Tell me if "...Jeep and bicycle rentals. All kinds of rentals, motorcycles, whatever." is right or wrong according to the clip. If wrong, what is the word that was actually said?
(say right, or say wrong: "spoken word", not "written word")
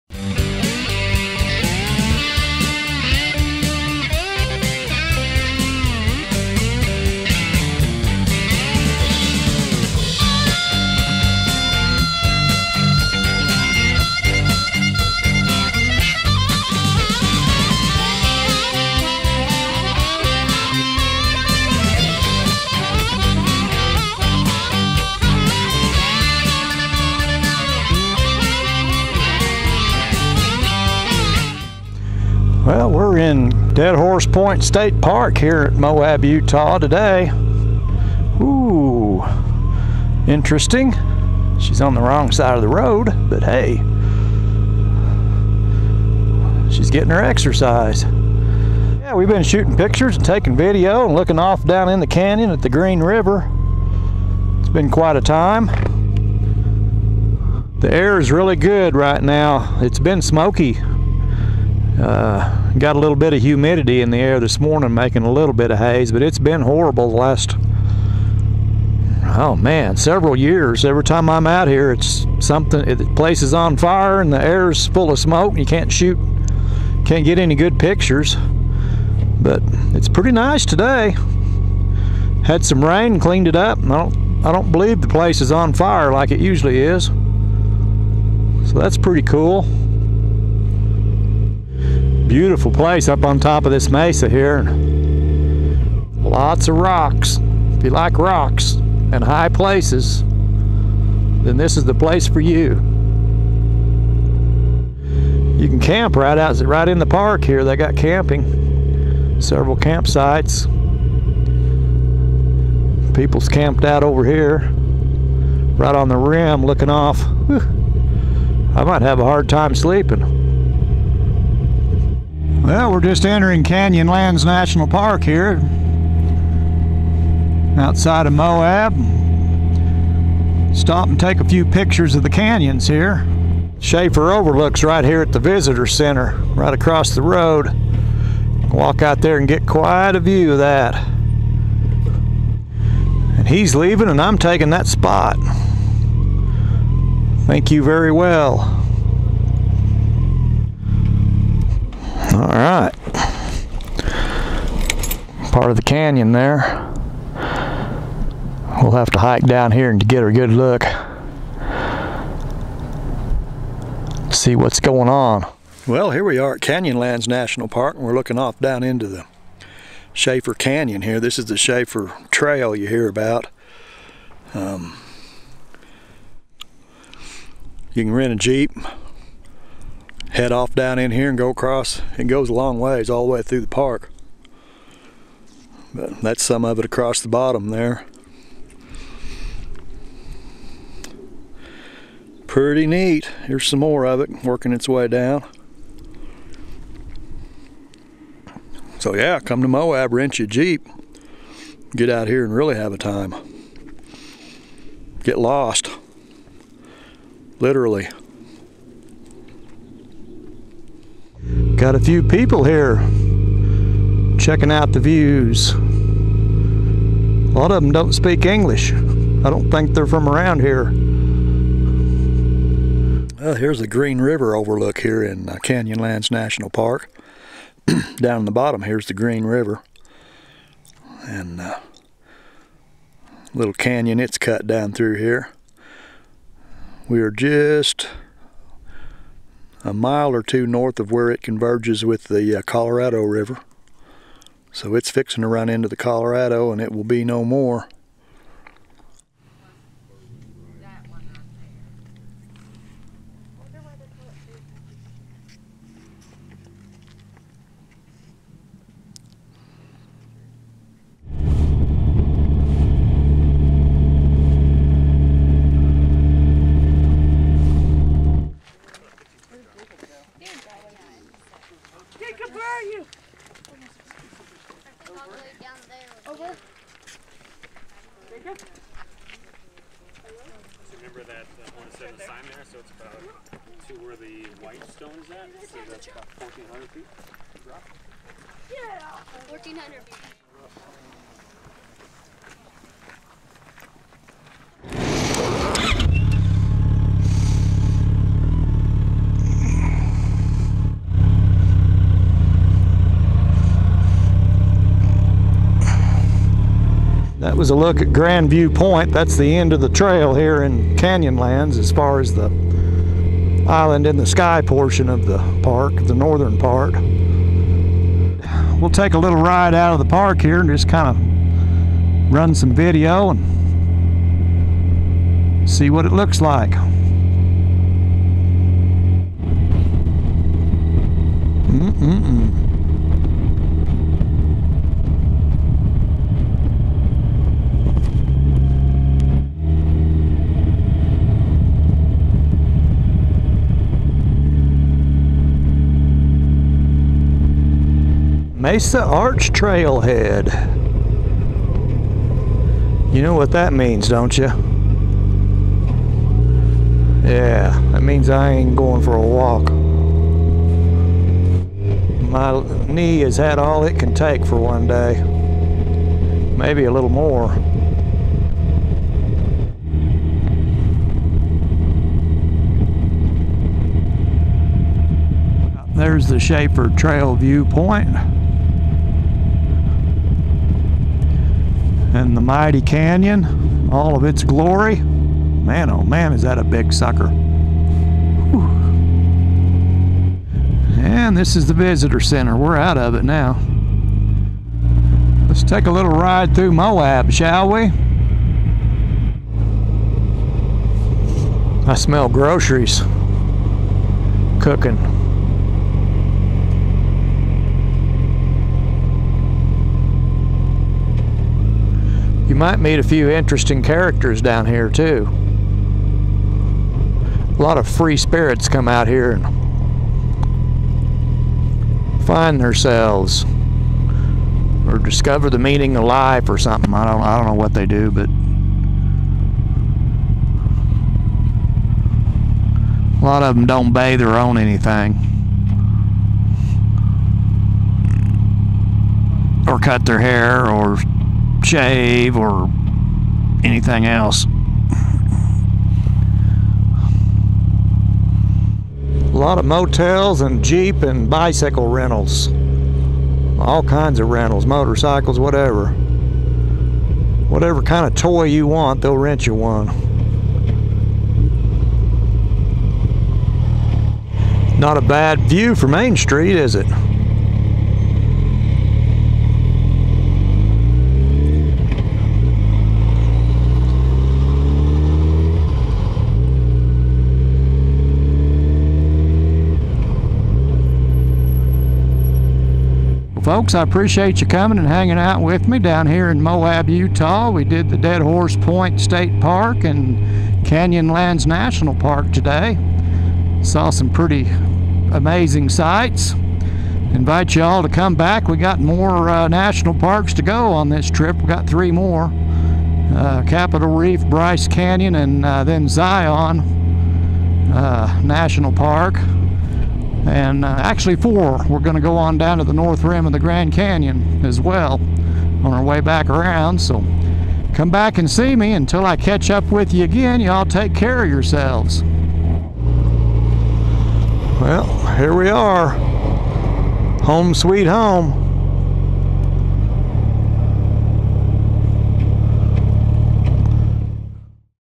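right.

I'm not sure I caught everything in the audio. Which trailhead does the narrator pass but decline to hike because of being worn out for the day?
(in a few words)
Mesa Arch Trailhead.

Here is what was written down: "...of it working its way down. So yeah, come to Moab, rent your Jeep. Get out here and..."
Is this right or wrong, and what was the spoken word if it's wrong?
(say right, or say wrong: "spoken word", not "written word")
right.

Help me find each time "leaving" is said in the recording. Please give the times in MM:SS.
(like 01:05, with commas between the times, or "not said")
02:23.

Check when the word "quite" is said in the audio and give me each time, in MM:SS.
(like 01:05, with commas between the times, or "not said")
00:54, 02:19.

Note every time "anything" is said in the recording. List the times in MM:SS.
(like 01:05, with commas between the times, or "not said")
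07:14, 07:23.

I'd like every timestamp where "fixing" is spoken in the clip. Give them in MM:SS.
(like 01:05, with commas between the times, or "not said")
04:05.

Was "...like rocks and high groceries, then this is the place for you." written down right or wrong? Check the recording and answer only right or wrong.
wrong.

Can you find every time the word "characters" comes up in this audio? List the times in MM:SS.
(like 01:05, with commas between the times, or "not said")
06:53.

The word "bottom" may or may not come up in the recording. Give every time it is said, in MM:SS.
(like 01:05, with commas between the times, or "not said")
03:07, 03:48.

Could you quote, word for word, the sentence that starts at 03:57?
We are just a mile or two north of where it converges with the uh, Colorado River.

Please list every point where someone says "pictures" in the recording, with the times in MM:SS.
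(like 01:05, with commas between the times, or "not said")
00:49, 01:17, 02:11.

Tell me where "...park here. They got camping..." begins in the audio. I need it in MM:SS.
01:47.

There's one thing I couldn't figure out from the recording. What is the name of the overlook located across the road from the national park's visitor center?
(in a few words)
Shafer Overlook.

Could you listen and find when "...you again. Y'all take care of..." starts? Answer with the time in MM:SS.
08:39.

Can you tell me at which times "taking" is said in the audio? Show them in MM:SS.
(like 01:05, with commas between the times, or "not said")
00:50, 02:24.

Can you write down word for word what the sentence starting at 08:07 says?
We did the Dead Horse Point State Park and Canyonlands National Park today.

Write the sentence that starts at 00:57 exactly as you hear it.
The air is really good right now.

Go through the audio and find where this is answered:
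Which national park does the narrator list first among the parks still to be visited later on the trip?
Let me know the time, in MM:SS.
08:23.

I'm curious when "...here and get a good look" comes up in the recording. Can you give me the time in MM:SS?
02:39.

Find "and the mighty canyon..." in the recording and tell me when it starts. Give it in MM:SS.
06:22.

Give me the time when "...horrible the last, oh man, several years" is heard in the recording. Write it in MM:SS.
01:06.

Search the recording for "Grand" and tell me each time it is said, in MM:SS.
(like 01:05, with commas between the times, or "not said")
05:08, 08:33.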